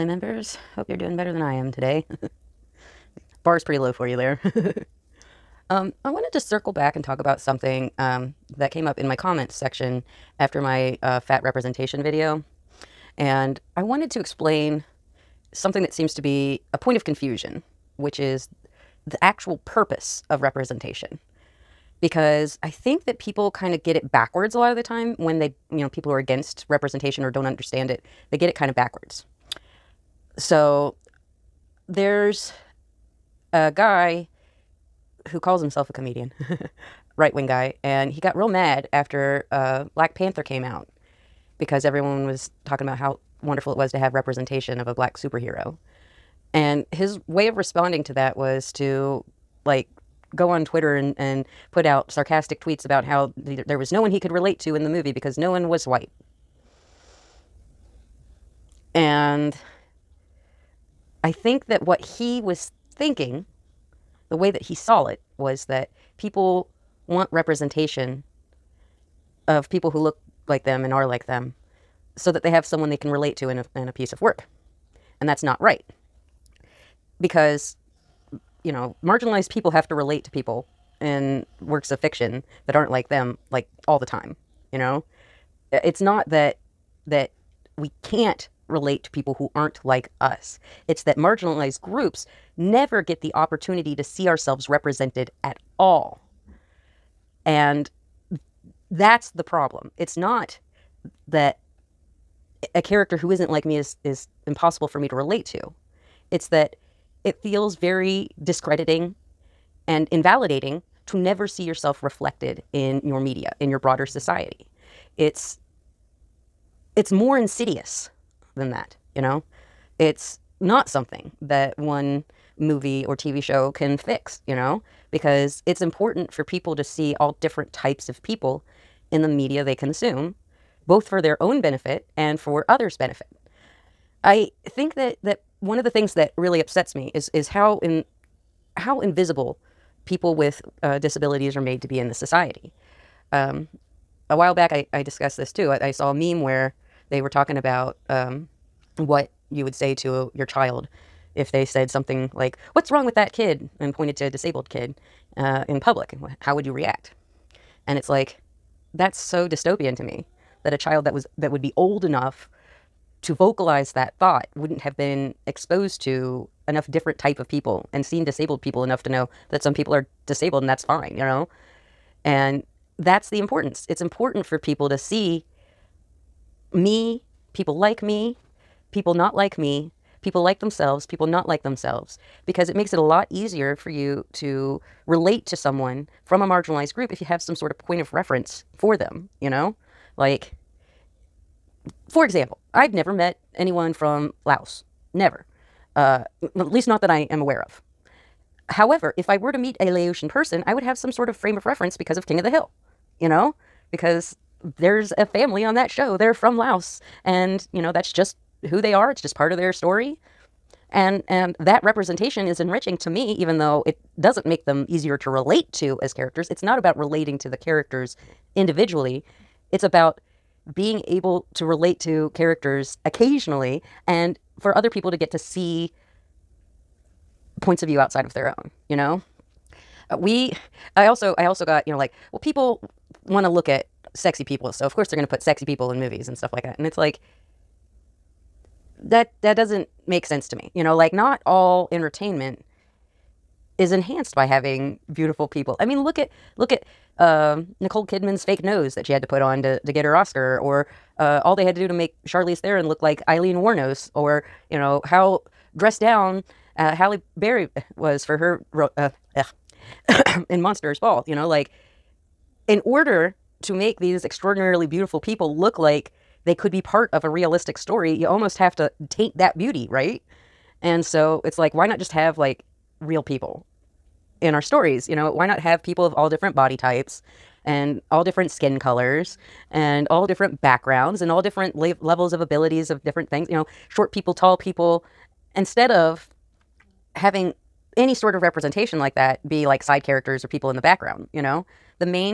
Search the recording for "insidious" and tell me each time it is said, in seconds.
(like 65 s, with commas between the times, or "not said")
117 s.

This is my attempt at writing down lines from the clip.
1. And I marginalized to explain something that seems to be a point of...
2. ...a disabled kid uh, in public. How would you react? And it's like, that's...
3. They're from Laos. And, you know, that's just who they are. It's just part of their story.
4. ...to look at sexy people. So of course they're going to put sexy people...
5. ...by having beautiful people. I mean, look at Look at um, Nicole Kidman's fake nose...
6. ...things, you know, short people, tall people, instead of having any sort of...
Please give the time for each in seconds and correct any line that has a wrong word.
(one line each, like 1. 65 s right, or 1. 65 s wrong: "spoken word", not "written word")
1. 13 s wrong: "wanted", not "marginalized"
2. 154 s right
3. 206 s right
4. 233 s right
5. 244 s right
6. 283 s right.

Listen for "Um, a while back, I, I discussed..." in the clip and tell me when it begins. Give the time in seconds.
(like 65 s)
143 s.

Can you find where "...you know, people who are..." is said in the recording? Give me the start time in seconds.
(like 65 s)
25 s.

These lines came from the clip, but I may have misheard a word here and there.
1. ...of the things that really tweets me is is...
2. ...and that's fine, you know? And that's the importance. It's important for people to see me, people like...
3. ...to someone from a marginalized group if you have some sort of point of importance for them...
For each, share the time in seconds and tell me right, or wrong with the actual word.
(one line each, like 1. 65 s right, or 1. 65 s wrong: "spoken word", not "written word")
1. 135 s wrong: "upsets", not "tweets"
2. 170 s right
3. 185 s wrong: "reference", not "importance".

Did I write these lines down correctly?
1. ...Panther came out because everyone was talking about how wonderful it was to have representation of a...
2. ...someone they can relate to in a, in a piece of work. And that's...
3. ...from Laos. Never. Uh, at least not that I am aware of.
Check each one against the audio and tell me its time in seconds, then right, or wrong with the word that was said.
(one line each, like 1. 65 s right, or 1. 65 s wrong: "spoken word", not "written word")
1. 40 s right
2. 72 s right
3. 193 s right.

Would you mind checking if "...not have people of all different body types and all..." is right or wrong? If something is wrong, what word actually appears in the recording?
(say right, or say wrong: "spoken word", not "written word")
right.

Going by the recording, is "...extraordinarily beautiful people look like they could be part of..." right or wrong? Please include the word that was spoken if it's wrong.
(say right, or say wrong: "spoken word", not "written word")
right.